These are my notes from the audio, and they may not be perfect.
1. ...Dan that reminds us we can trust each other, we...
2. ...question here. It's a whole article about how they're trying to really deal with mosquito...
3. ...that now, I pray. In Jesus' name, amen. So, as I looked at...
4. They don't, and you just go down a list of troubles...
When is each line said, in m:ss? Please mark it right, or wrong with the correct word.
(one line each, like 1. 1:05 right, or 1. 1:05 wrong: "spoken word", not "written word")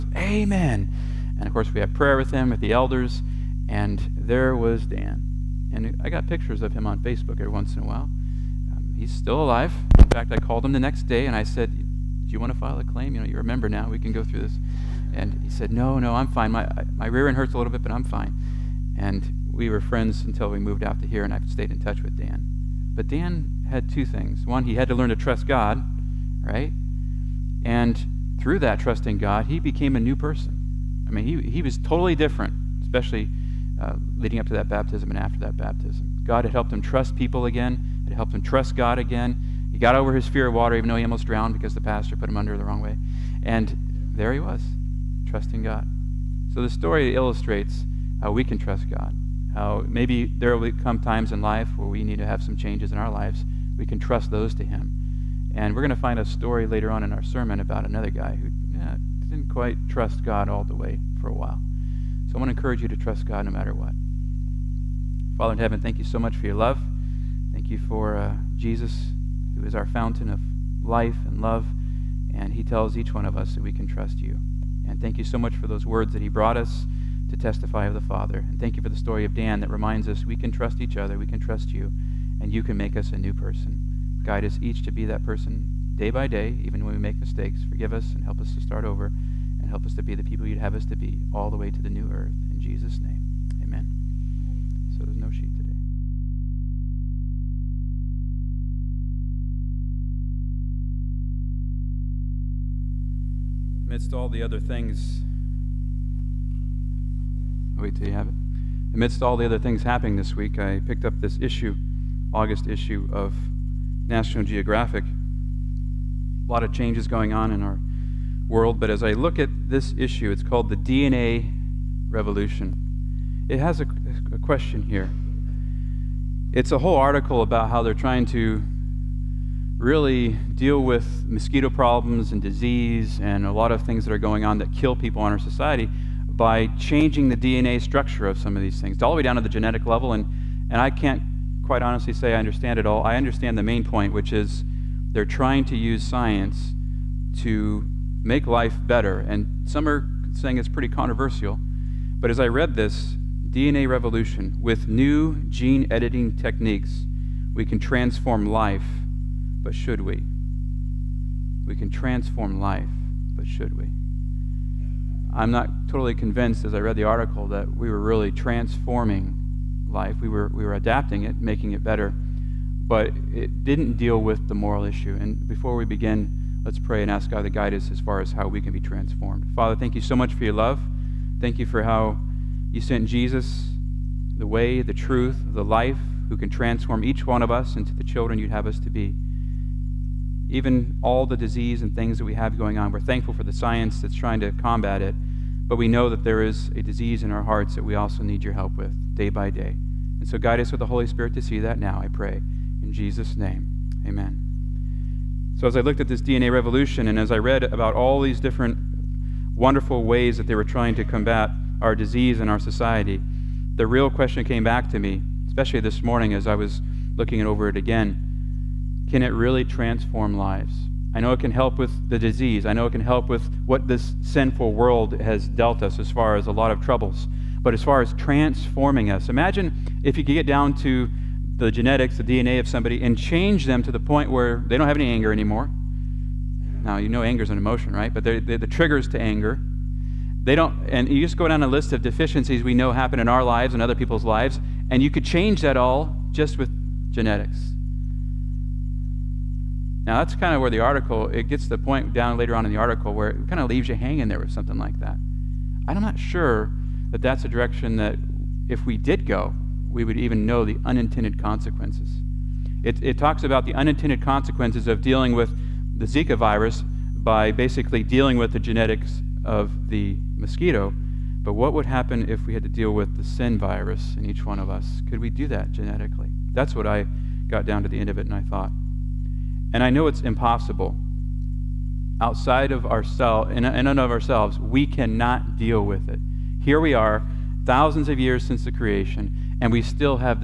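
1. 1:19 right
2. 2:04 right
3. 3:21 right
4. 4:00 wrong: "deficiencies", not "troubles".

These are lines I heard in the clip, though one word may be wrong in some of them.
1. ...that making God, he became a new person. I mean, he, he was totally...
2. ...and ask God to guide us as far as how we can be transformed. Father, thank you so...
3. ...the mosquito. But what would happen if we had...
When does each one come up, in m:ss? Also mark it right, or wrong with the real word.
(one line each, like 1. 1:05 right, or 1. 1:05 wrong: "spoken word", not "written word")
1. 0:28 wrong: "trusting", not "making"
2. 2:57 right
3. 4:29 right.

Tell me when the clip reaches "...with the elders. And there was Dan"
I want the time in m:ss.
0:02.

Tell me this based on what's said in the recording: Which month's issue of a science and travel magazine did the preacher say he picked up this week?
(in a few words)
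August.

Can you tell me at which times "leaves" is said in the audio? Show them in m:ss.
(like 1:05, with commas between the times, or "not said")
4:13.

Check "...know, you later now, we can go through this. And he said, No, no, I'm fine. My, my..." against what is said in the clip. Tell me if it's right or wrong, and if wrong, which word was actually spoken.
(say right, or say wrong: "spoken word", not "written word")
wrong: "remember", not "later".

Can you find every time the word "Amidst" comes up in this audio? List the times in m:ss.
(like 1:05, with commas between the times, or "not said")
1:43, 1:48.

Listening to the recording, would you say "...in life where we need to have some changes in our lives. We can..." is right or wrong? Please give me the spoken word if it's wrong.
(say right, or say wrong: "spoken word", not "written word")
right.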